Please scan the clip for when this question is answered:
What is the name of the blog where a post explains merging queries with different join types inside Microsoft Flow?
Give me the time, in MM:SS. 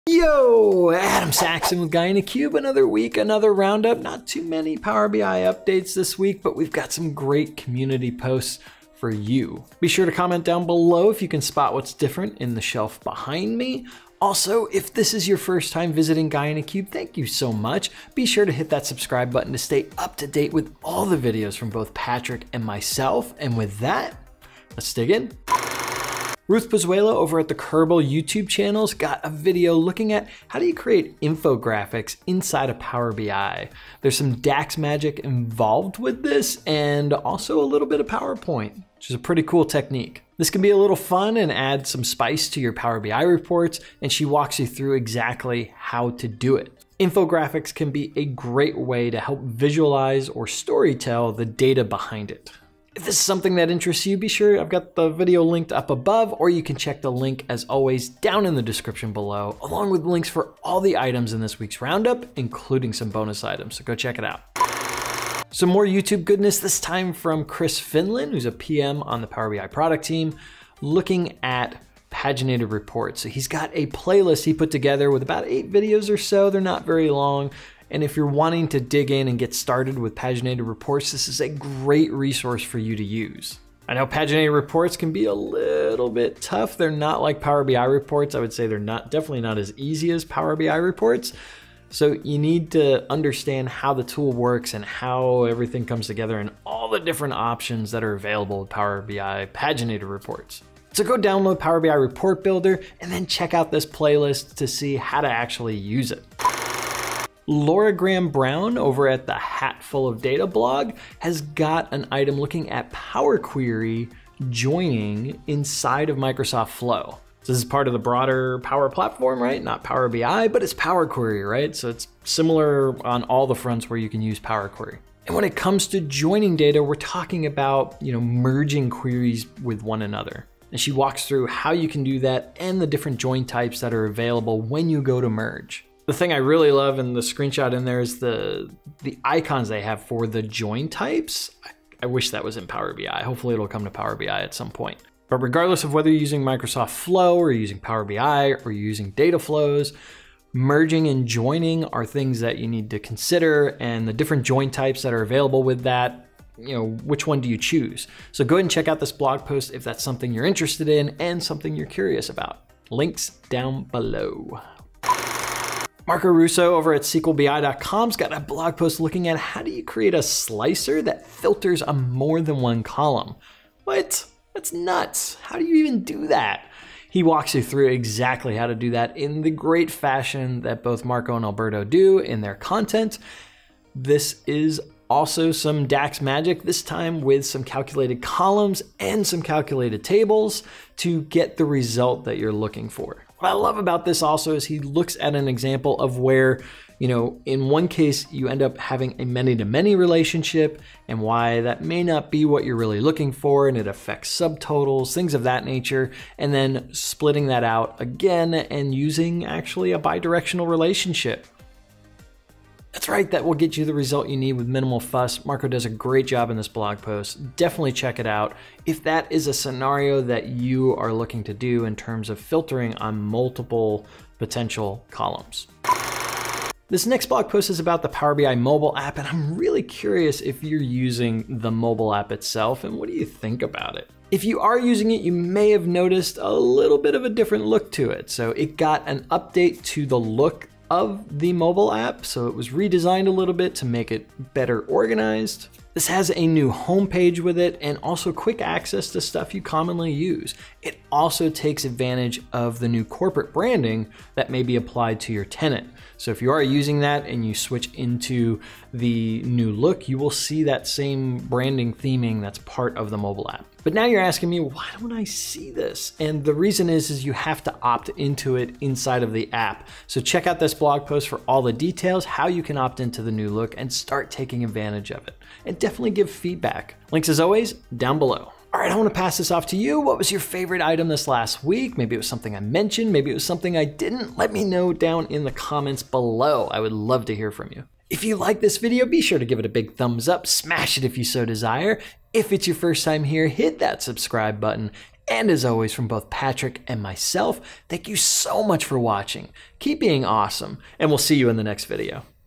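01:49.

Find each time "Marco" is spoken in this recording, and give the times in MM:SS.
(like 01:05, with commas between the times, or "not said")
02:46, 03:01, 03:35.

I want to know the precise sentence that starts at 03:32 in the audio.
That's right, that will get you the result you need with minimal fuss.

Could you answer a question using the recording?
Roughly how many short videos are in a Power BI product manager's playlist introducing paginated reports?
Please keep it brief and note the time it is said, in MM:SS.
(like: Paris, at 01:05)
8, at 01:15.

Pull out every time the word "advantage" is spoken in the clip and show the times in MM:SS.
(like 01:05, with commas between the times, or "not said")
04:11, 04:34.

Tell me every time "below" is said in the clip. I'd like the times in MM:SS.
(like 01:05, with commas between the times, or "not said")
00:10, 00:59, 02:43, 04:38, 04:46.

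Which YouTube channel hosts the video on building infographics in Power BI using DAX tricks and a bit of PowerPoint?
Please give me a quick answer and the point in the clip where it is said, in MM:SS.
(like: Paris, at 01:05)
Curbal, at 00:27.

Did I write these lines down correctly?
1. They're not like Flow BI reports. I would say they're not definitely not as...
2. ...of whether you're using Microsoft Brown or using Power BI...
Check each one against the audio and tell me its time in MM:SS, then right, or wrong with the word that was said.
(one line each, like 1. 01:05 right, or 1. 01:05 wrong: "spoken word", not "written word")
1. 01:26 wrong: "Power", not "Flow"
2. 02:25 wrong: "Flow", not "Brown".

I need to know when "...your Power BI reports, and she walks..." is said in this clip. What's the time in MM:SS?
00:42.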